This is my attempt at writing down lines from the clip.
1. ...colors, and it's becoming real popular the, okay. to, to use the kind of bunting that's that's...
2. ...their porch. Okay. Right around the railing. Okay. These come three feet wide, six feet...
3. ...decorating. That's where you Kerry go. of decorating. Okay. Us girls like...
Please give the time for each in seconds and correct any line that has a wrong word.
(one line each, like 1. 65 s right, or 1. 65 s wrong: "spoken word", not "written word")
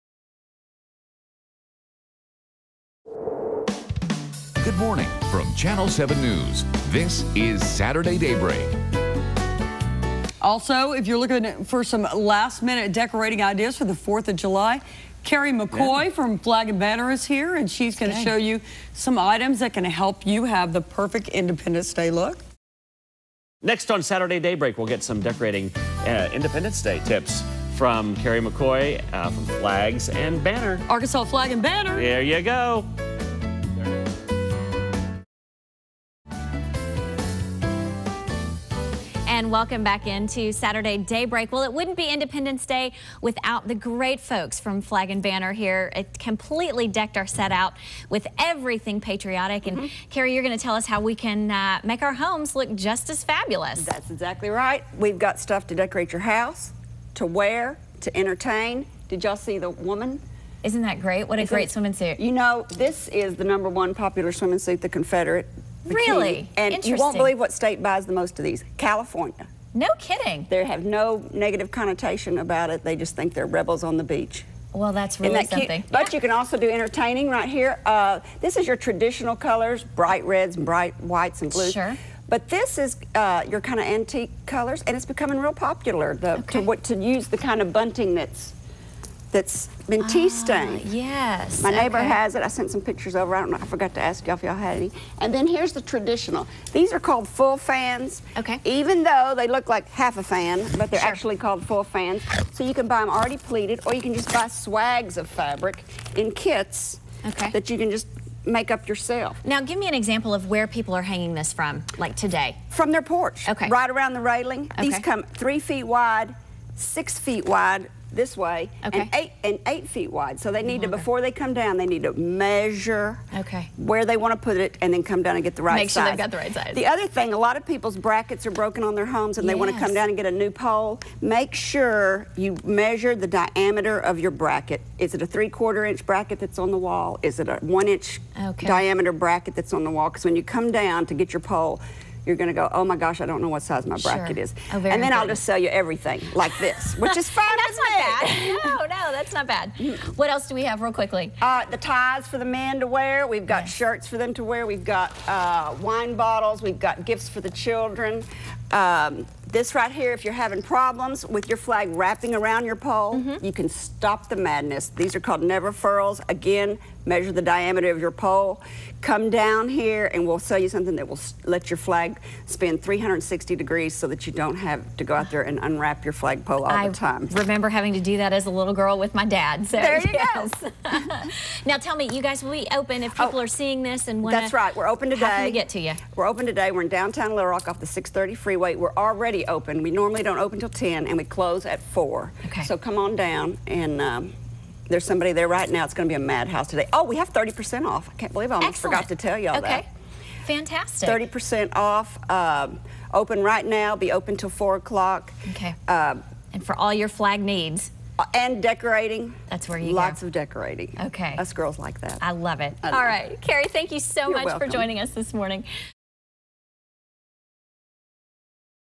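1. 84 s right
2. 112 s right
3. 208 s wrong: "Lots", not "Kerry".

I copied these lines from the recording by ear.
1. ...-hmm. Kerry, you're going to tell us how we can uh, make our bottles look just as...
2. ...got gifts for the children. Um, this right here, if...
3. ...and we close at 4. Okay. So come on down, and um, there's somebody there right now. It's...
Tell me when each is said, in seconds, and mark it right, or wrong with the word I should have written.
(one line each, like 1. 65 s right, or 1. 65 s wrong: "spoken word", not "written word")
1. 49 s wrong: "homes", not "bottles"
2. 156 s right
3. 191 s right.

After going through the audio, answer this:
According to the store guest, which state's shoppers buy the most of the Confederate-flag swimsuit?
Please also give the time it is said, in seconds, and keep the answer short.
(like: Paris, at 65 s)
California, at 68 s.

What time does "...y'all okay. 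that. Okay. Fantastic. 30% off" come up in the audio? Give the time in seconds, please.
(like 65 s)
199 s.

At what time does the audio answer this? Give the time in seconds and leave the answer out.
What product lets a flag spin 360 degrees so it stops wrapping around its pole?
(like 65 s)
165 s.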